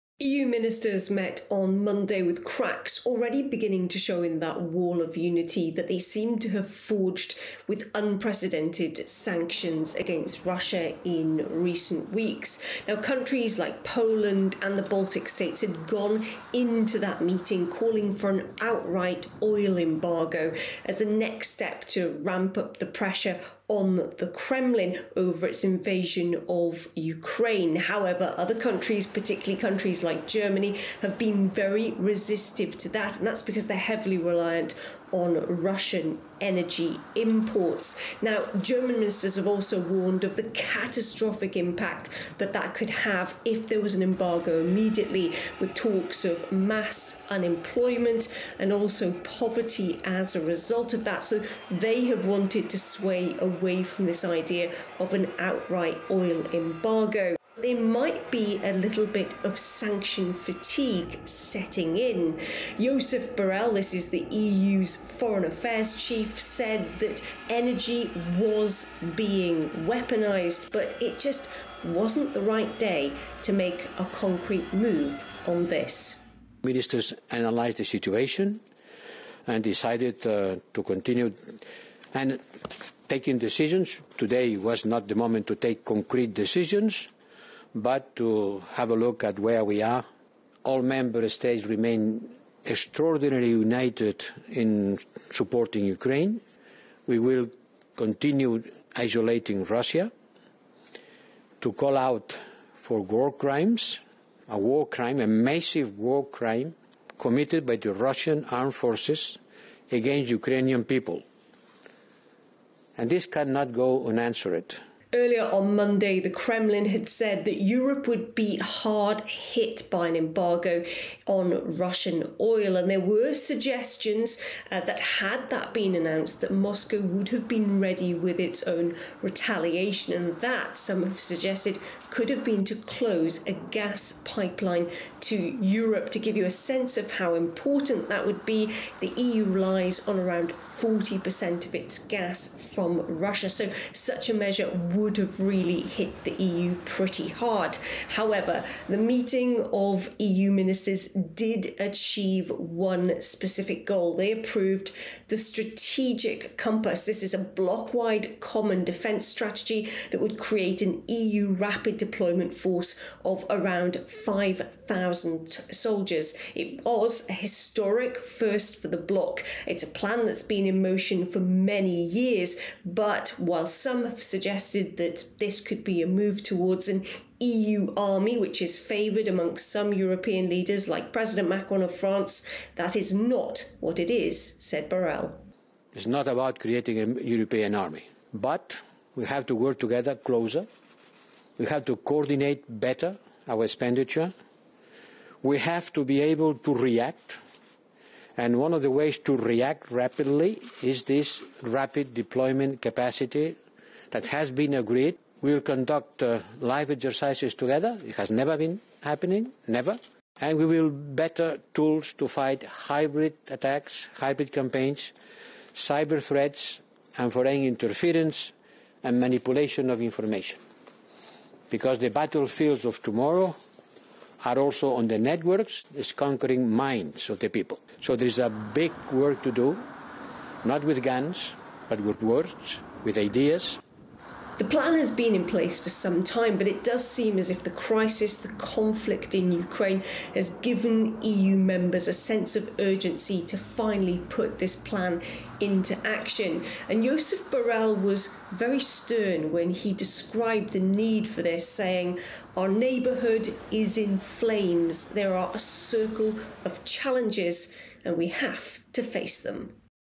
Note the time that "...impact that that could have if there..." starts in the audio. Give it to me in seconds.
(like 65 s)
41 s.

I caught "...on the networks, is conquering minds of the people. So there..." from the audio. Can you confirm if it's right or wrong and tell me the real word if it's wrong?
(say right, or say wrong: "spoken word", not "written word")
right.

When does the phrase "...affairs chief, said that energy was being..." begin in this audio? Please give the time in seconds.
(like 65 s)
65 s.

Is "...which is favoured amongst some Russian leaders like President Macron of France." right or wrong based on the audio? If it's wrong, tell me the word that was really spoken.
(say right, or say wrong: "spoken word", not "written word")
wrong: "European", not "Russian".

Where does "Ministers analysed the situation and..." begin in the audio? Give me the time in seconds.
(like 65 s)
76 s.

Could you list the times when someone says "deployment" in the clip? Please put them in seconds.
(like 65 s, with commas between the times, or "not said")
161 s, 202 s.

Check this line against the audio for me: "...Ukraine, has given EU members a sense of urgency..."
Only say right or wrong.
right.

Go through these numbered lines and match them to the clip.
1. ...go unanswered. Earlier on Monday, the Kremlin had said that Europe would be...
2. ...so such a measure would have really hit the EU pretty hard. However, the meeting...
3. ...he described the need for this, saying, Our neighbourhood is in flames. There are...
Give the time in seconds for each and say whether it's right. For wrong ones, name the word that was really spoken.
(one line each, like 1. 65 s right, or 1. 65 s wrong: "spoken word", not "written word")
1. 113 s right
2. 143 s right
3. 249 s right.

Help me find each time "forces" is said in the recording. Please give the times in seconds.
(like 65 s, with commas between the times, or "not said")
108 s, 162 s.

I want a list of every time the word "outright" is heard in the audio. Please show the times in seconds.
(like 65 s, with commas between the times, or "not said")
18 s, 55 s.